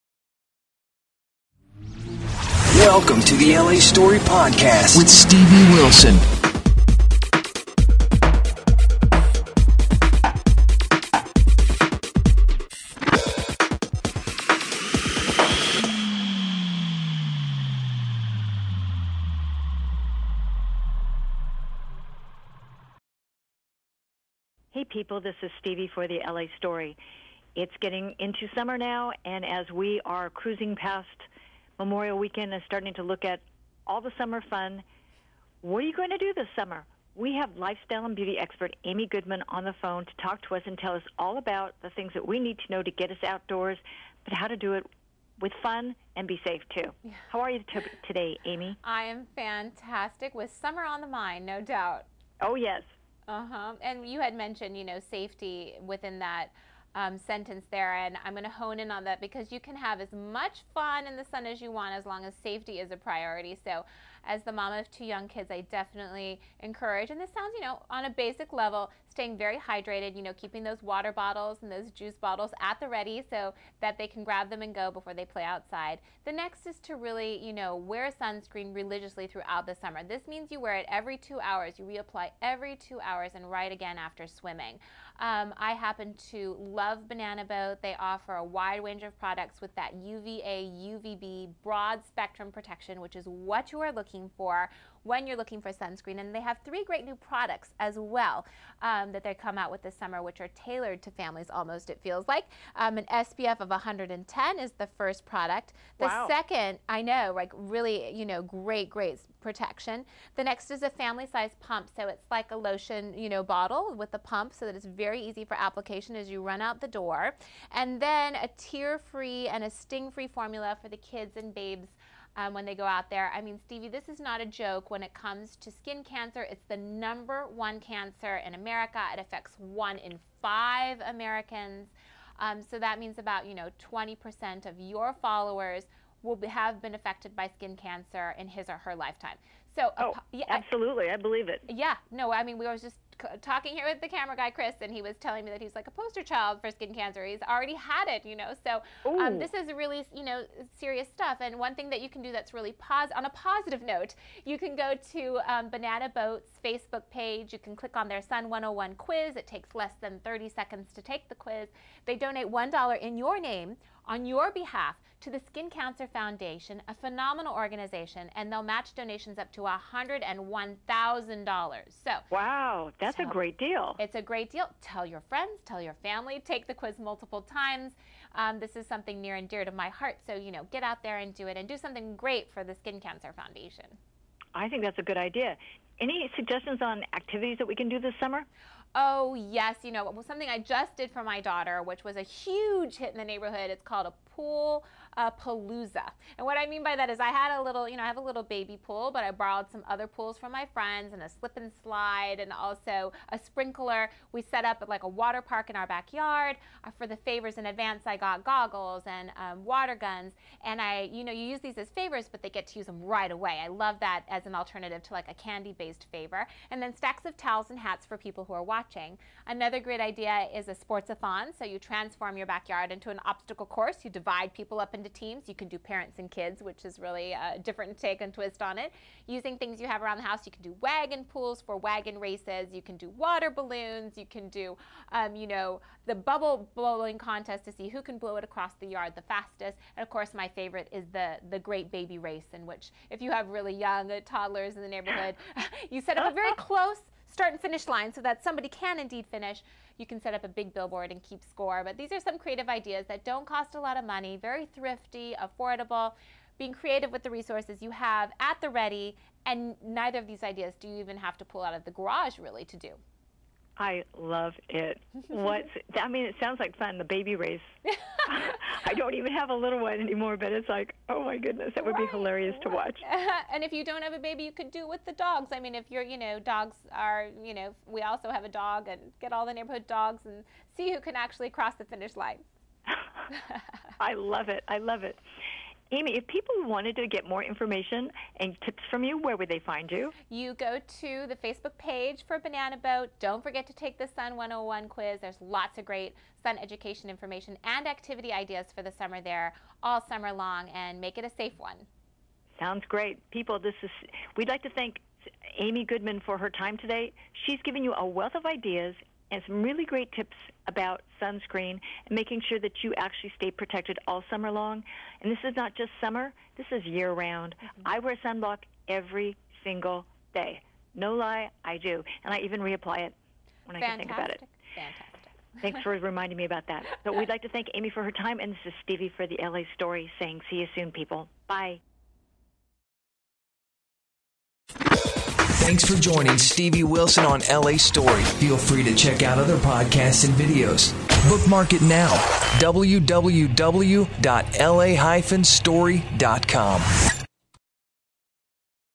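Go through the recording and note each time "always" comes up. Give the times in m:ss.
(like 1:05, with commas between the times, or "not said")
2:22.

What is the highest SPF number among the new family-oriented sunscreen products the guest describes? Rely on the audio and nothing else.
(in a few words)
110.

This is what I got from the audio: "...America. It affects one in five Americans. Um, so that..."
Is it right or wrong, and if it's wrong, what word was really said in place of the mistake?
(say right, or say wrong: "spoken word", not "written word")
right.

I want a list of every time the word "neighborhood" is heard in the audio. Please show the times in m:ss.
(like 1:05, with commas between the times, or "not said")
3:13, 4:04, 4:39.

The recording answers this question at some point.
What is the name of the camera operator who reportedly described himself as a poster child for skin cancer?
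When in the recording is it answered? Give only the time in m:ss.
2:24.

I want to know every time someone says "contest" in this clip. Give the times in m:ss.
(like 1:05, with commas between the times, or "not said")
3:57.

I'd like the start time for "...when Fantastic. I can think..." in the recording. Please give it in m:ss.
5:23.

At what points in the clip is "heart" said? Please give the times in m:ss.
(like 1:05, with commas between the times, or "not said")
2:59.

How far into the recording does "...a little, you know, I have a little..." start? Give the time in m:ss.
3:17.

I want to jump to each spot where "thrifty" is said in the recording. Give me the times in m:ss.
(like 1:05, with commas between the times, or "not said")
4:14.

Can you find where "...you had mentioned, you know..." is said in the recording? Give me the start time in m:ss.
0:54.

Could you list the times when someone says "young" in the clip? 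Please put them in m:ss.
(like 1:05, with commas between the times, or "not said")
1:05, 4:03.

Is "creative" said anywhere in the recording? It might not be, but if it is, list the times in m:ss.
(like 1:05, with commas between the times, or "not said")
4:12, 4:16.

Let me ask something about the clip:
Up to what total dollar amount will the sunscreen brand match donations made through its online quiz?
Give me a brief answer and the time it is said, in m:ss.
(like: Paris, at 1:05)
$101,000, at 2:49.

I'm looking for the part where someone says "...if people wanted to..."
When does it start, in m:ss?
4:46.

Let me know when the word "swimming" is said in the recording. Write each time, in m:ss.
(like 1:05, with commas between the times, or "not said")
1:24.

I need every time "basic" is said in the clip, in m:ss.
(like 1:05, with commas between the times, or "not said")
1:08.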